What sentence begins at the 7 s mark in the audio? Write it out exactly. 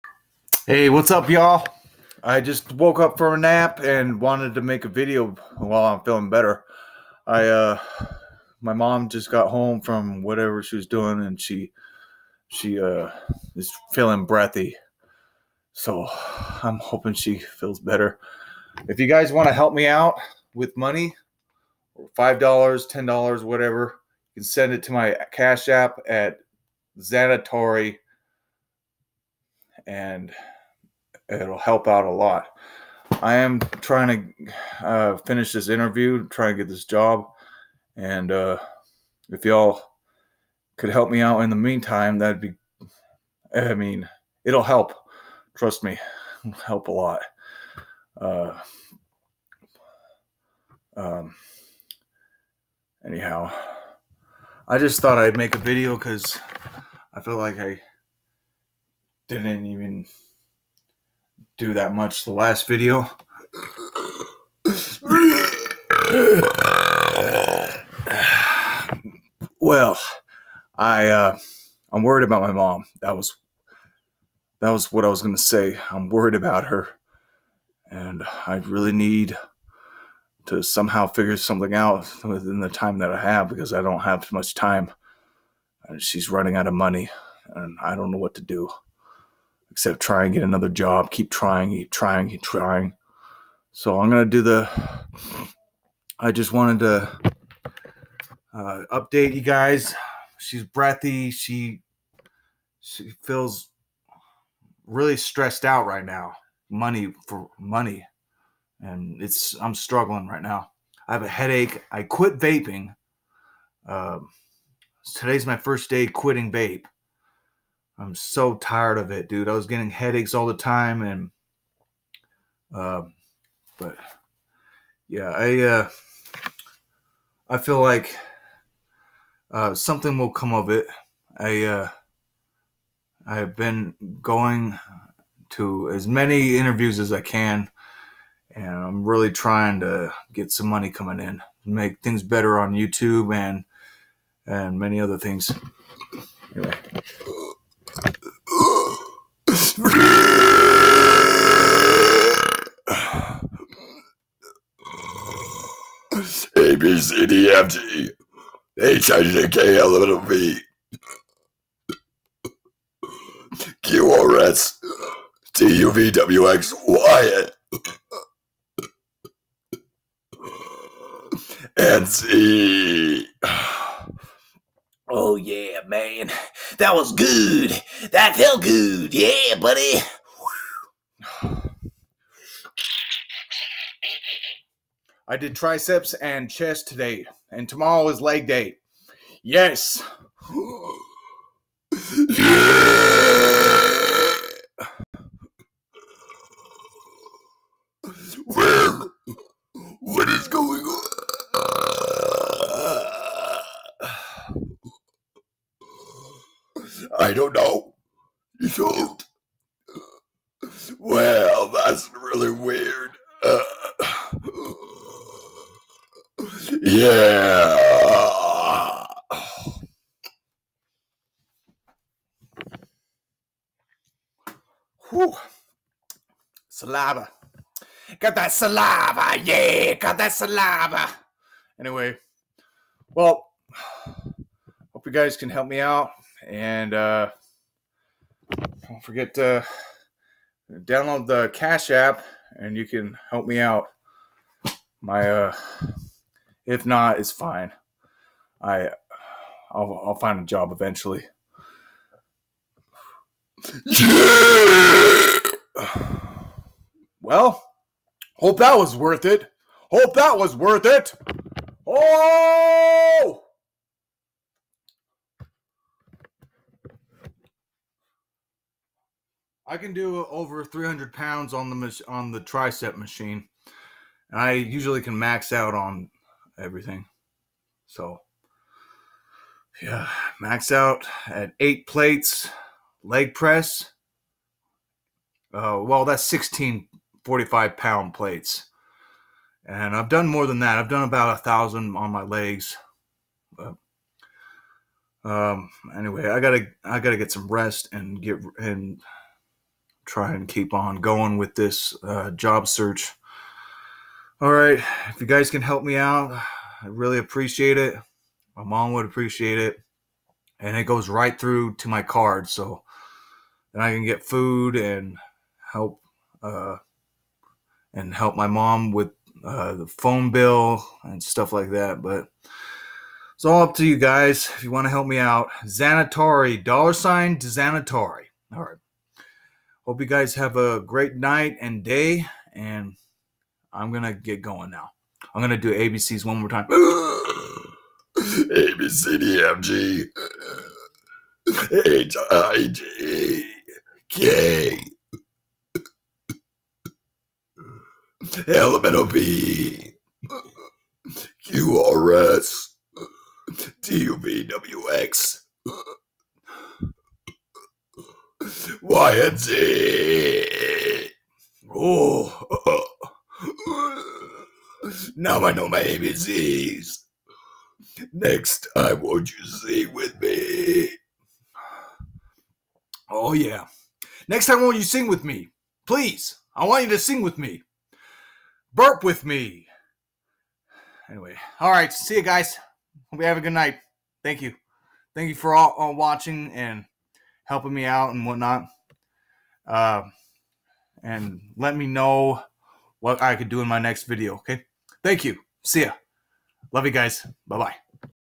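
I, uh, my mom just got home from whatever she was doing and she, she, uh, is feeling breathy.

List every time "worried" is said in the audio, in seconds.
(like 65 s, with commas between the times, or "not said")
72 s, 76 s.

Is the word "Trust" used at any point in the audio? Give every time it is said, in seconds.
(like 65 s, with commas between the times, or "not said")
45 s.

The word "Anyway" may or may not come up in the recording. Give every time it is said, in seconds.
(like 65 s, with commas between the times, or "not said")
146 s, 231 s, 295 s, 381 s.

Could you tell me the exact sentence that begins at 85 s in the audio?
And she's running out of money, and I don't know what to do except try and get another job.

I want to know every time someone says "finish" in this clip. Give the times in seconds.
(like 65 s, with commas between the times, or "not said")
35 s.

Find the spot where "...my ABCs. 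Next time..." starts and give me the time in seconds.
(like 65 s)
365 s.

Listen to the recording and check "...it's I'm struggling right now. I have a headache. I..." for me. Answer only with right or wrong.
right.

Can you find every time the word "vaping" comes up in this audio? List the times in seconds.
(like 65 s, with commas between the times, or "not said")
112 s.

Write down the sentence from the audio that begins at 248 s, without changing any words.
I I'll, I'll find a job eventually.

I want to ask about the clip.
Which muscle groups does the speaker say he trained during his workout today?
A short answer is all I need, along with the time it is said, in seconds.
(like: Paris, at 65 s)
triceps and chest, at 185 s.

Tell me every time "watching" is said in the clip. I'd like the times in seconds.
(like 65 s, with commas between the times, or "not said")
385 s.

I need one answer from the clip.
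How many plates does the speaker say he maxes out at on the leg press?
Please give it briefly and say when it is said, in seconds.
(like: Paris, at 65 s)
8 plates, at 281 s.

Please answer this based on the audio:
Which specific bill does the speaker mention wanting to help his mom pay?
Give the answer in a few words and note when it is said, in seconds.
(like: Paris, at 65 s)
phone bill, at 319 s.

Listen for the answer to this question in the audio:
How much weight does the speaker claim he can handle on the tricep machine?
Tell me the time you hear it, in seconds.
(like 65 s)
270 s.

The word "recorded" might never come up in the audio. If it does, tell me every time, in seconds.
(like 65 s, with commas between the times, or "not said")
not said.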